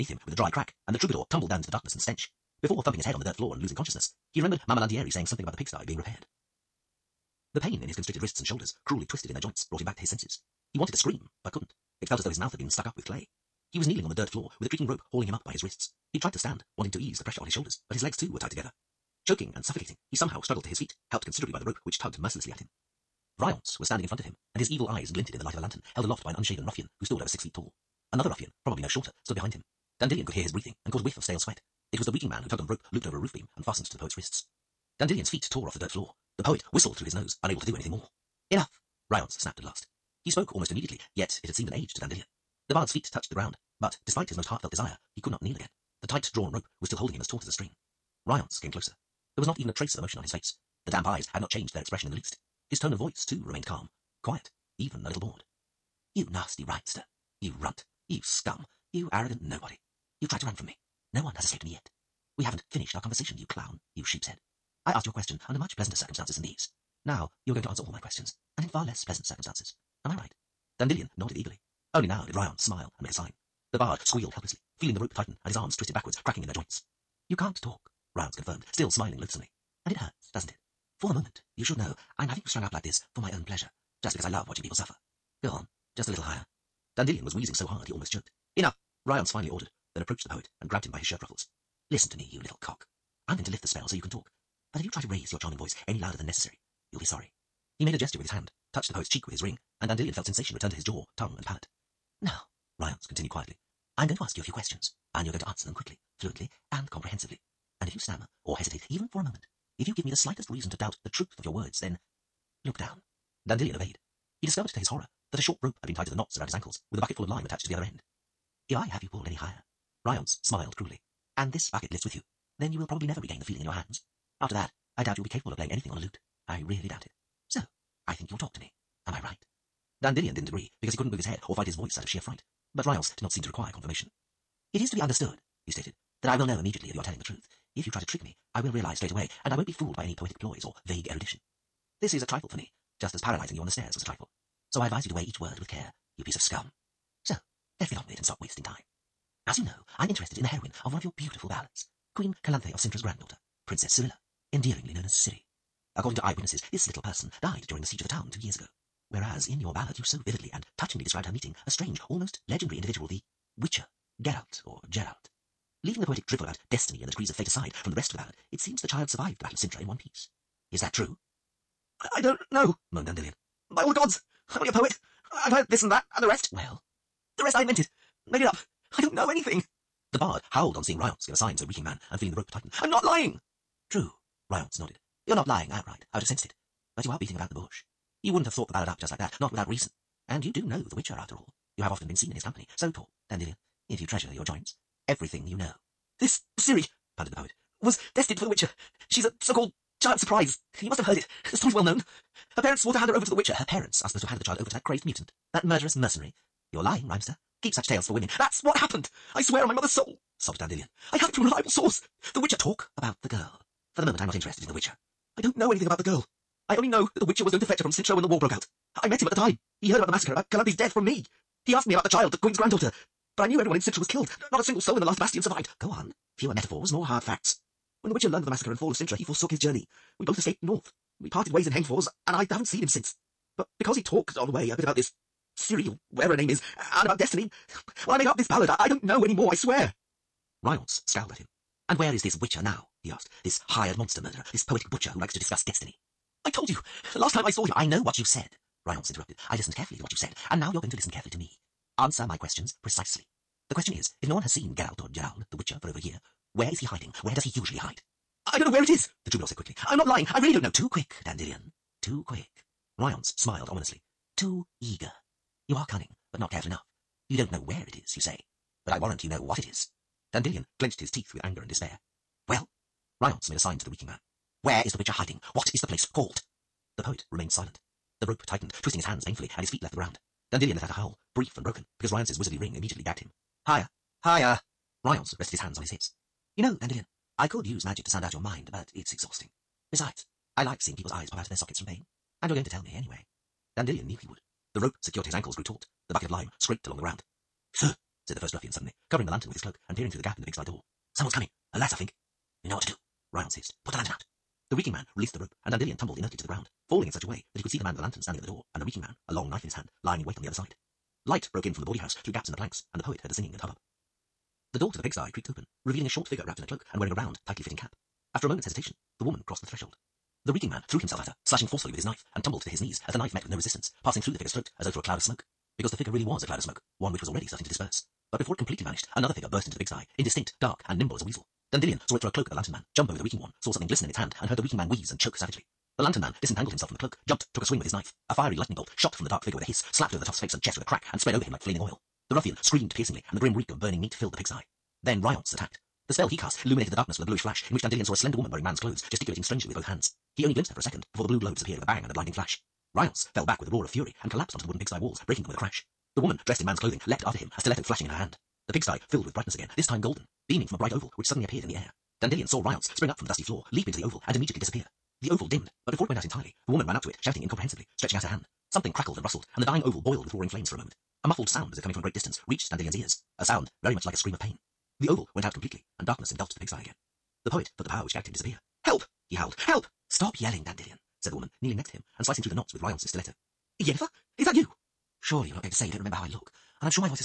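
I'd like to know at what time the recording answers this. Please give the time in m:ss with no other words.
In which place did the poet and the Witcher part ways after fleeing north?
3:51.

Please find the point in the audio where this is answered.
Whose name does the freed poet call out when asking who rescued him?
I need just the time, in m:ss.
6:23.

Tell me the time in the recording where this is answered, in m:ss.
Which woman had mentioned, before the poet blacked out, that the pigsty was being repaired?
0:04.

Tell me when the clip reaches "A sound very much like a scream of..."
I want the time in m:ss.
6:13.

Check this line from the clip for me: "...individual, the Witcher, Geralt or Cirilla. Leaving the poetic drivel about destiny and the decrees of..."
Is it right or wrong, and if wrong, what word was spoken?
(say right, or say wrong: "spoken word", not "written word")
wrong: "Gerald", not "Cirilla".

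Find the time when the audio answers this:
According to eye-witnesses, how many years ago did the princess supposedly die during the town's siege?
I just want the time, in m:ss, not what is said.
2:38.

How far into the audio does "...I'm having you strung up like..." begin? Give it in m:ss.
1:22.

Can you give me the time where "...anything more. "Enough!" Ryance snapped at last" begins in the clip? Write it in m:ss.
0:37.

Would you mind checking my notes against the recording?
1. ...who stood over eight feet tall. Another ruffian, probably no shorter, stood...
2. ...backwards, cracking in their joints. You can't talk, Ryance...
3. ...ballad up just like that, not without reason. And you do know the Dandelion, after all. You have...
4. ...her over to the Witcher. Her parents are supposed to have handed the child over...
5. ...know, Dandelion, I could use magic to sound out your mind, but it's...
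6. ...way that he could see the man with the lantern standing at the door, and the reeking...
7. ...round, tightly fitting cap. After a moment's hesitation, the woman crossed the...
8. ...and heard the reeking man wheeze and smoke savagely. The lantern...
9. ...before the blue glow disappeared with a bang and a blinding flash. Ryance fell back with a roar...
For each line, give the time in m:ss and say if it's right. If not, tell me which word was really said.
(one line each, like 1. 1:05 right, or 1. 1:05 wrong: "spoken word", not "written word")
1. 0:26 wrong: "six", not "eight"
2. 1:15 right
3. 3:08 wrong: "Witcher", not "Dandelion"
4. 3:23 right
5. 4:46 right
6. 5:07 right
7. 5:17 right
8. 5:34 wrong: "choke", not "smoke"
9. 5:51 right.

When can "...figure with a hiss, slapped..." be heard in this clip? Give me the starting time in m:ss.
5:39.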